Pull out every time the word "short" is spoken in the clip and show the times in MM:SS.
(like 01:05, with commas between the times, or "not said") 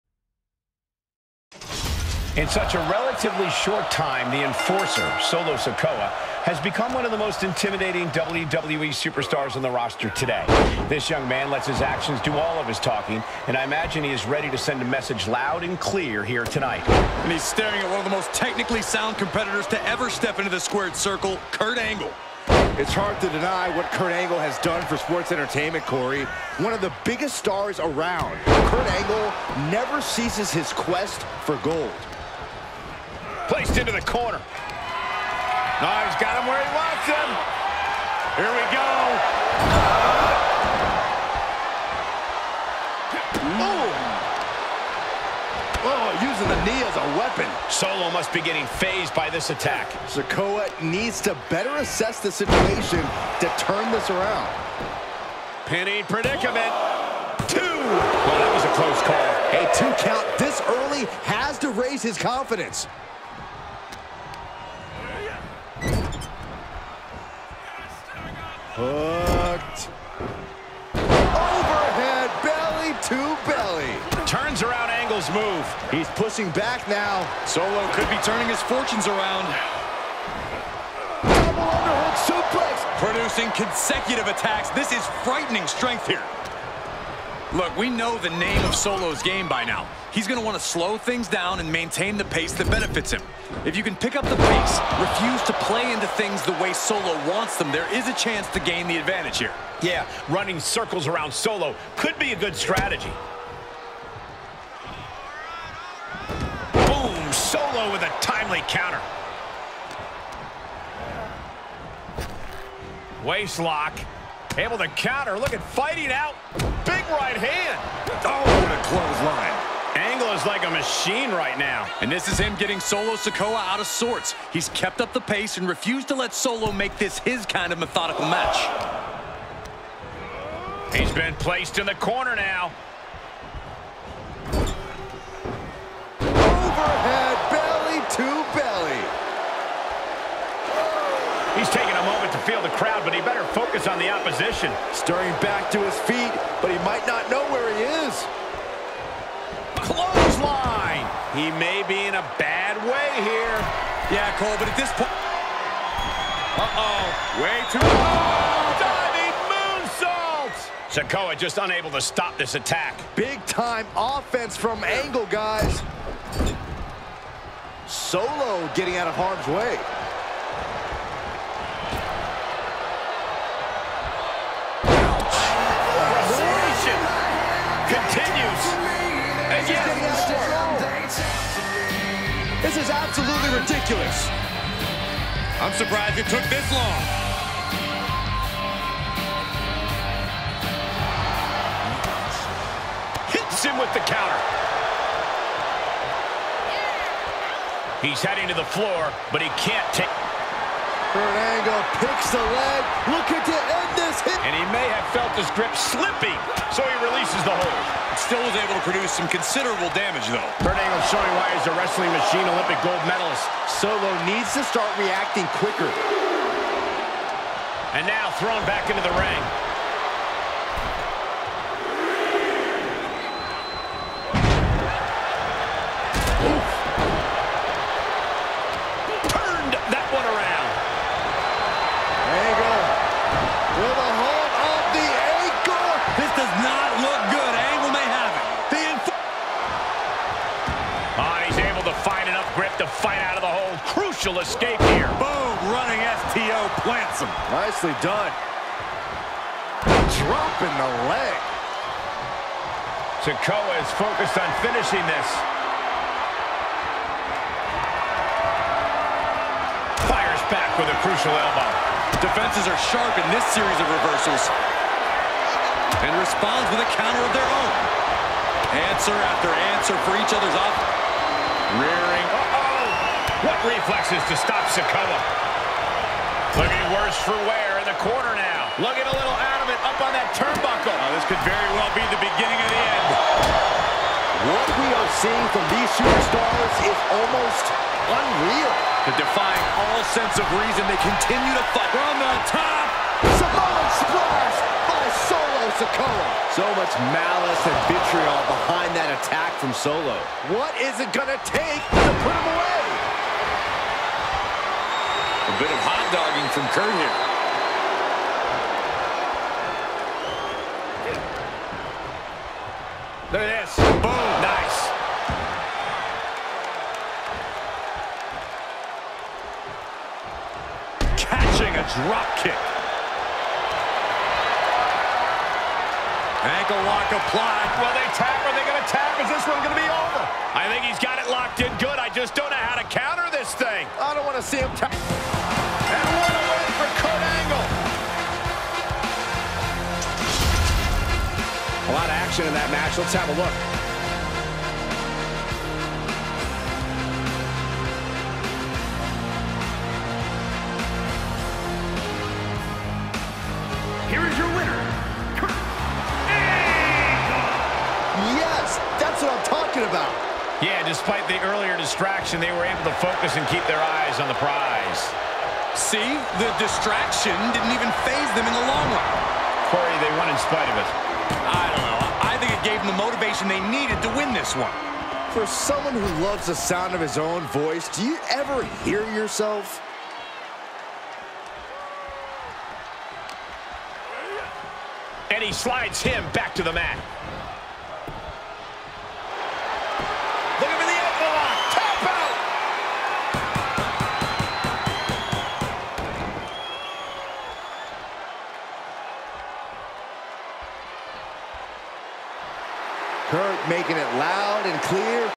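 00:03.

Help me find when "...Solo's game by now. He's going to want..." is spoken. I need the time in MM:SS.
01:28.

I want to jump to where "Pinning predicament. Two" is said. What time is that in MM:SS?
00:55.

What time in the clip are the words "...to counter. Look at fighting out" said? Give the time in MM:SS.
01:54.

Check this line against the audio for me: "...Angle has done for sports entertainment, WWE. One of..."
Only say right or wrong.
wrong.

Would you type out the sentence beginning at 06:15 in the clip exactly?
For someone who loves the sound of his own voice, do you ever hear yourself?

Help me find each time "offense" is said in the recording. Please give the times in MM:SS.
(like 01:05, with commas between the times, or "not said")
02:43, 04:30.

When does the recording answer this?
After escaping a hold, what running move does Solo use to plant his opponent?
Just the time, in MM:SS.
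04:05.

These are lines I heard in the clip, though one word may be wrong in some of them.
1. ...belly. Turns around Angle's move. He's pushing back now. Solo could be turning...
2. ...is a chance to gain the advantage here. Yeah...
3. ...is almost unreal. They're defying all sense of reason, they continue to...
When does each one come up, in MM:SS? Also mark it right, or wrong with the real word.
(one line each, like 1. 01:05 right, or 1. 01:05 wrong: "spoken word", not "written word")
1. 01:13 right
2. 01:37 right
3. 04:46 right.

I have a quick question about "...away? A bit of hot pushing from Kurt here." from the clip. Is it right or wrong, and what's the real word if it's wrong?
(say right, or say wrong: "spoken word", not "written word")
wrong: "dogging", not "pushing".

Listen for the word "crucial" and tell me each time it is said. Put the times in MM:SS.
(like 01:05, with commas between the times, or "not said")
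04:03, 04:21.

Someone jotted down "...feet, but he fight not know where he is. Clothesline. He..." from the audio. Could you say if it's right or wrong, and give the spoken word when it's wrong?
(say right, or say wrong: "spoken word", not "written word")
wrong: "might", not "fight".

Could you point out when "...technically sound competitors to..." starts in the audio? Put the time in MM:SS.
00:18.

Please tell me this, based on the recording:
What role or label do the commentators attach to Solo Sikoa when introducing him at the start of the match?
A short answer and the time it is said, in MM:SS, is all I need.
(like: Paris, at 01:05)
The enforcer, at 00:04.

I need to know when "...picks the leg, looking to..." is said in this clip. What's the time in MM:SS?
03:21.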